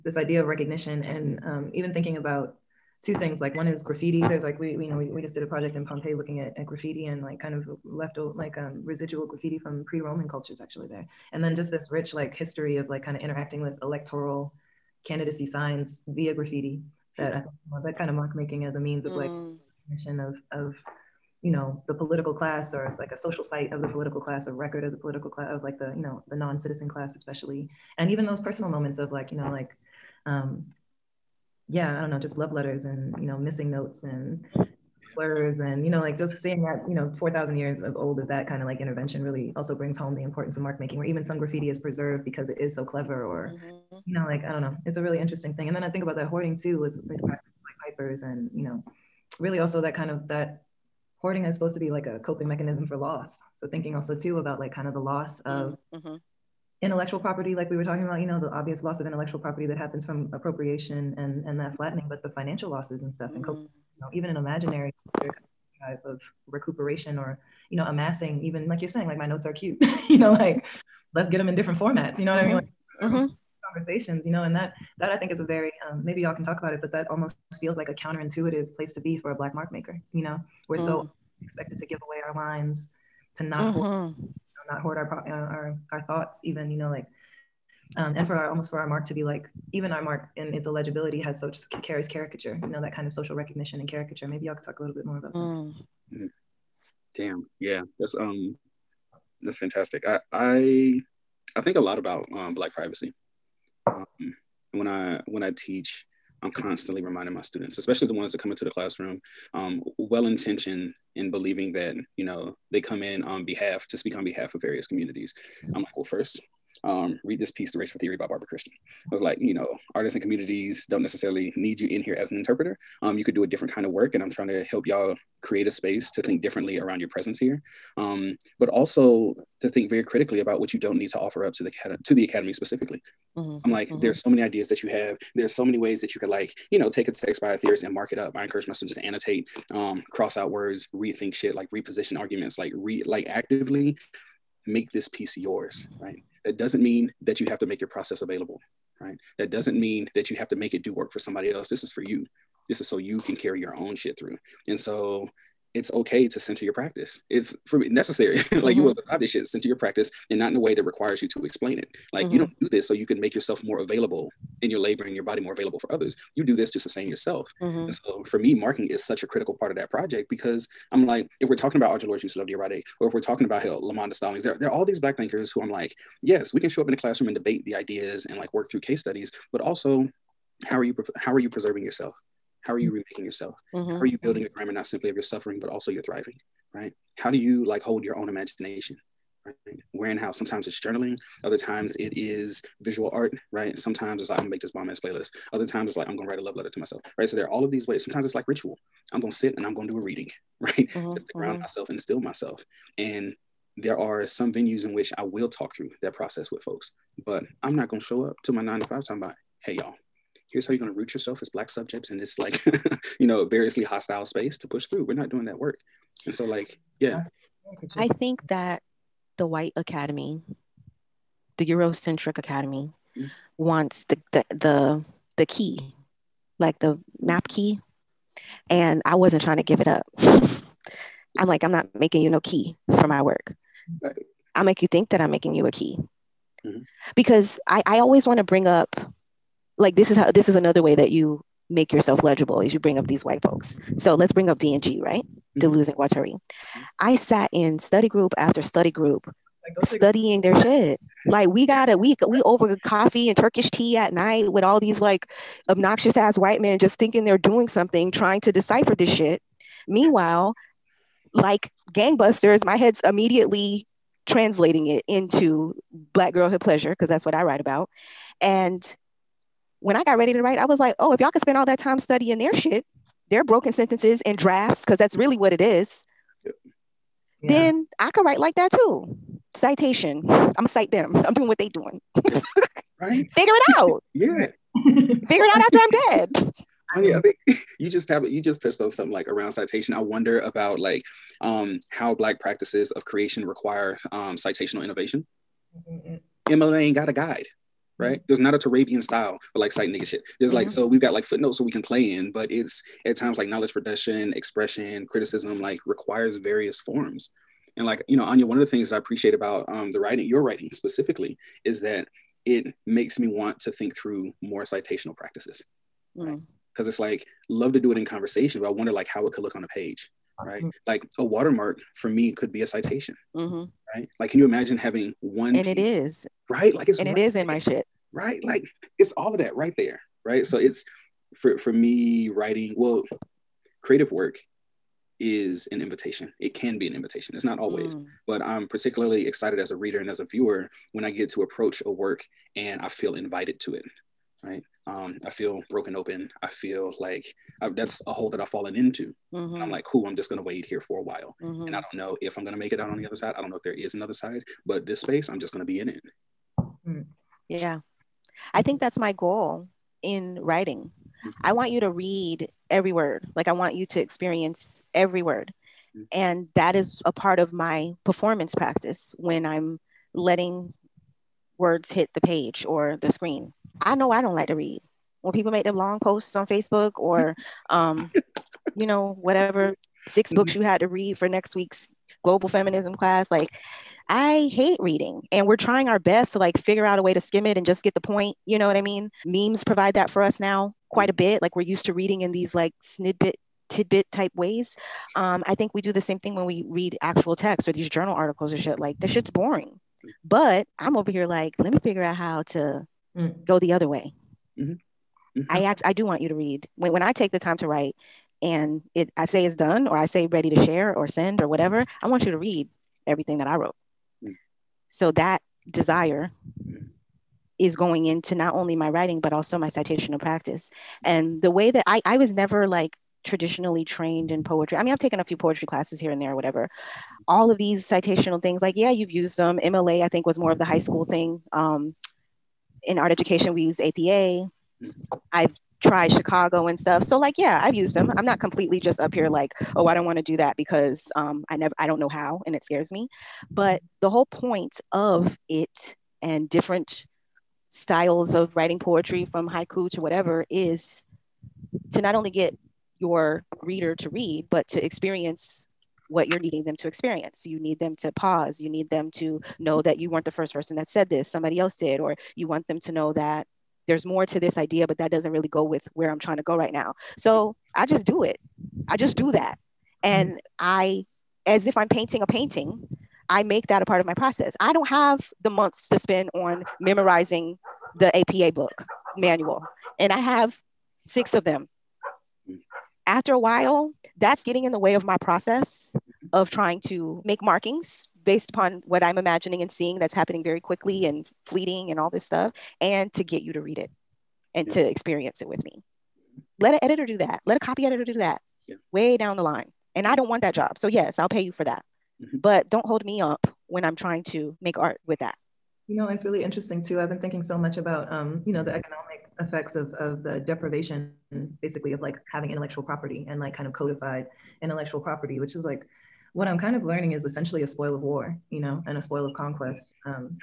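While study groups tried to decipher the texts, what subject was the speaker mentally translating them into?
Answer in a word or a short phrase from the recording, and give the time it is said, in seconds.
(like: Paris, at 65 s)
Black girlhood pleasure, at 266 s.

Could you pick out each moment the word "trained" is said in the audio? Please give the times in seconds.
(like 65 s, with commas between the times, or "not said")
423 s.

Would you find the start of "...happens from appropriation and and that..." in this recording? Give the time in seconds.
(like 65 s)
59 s.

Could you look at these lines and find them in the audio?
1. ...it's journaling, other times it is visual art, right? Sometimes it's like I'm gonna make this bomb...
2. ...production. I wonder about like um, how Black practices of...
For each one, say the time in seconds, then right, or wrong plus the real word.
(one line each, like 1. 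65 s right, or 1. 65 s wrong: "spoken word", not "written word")
1. 190 s right
2. 289 s wrong: "citation", not "production".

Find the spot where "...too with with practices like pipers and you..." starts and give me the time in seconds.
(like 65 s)
46 s.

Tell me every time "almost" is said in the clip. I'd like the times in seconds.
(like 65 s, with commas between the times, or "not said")
77 s, 88 s.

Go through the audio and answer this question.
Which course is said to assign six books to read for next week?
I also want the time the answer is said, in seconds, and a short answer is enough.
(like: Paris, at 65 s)
Global feminism, at 382 s.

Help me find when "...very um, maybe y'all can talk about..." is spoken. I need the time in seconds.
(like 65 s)
75 s.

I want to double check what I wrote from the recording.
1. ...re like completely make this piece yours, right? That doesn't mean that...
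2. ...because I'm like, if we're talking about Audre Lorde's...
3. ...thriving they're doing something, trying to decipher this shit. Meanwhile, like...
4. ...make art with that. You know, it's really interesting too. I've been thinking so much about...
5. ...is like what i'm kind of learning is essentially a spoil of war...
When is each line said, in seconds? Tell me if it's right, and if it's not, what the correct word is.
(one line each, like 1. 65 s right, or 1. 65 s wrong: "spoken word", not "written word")
1. 142 s wrong: "actively", not "completely"
2. 170 s right
3. 256 s wrong: "thinking", not "thriving"
4. 504 s right
5. 515 s right.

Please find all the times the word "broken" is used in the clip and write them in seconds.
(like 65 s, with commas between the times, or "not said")
273 s, 345 s.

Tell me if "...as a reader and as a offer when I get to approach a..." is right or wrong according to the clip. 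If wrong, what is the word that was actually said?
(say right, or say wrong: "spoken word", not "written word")
wrong: "viewer", not "offer".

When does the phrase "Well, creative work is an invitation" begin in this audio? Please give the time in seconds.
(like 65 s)
332 s.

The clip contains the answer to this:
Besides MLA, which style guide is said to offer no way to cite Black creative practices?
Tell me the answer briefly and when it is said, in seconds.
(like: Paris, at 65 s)
Turabian, at 298 s.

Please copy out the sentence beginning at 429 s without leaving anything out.
MLA, I think, was more of the high school thing.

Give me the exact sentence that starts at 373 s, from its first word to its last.
I know I don't like to read.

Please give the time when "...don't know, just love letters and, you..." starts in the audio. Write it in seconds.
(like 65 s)
32 s.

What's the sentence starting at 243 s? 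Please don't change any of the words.
So let's bring up D and G, right?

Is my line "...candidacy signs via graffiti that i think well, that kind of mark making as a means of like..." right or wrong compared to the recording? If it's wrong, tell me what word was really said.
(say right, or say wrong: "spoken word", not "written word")
right.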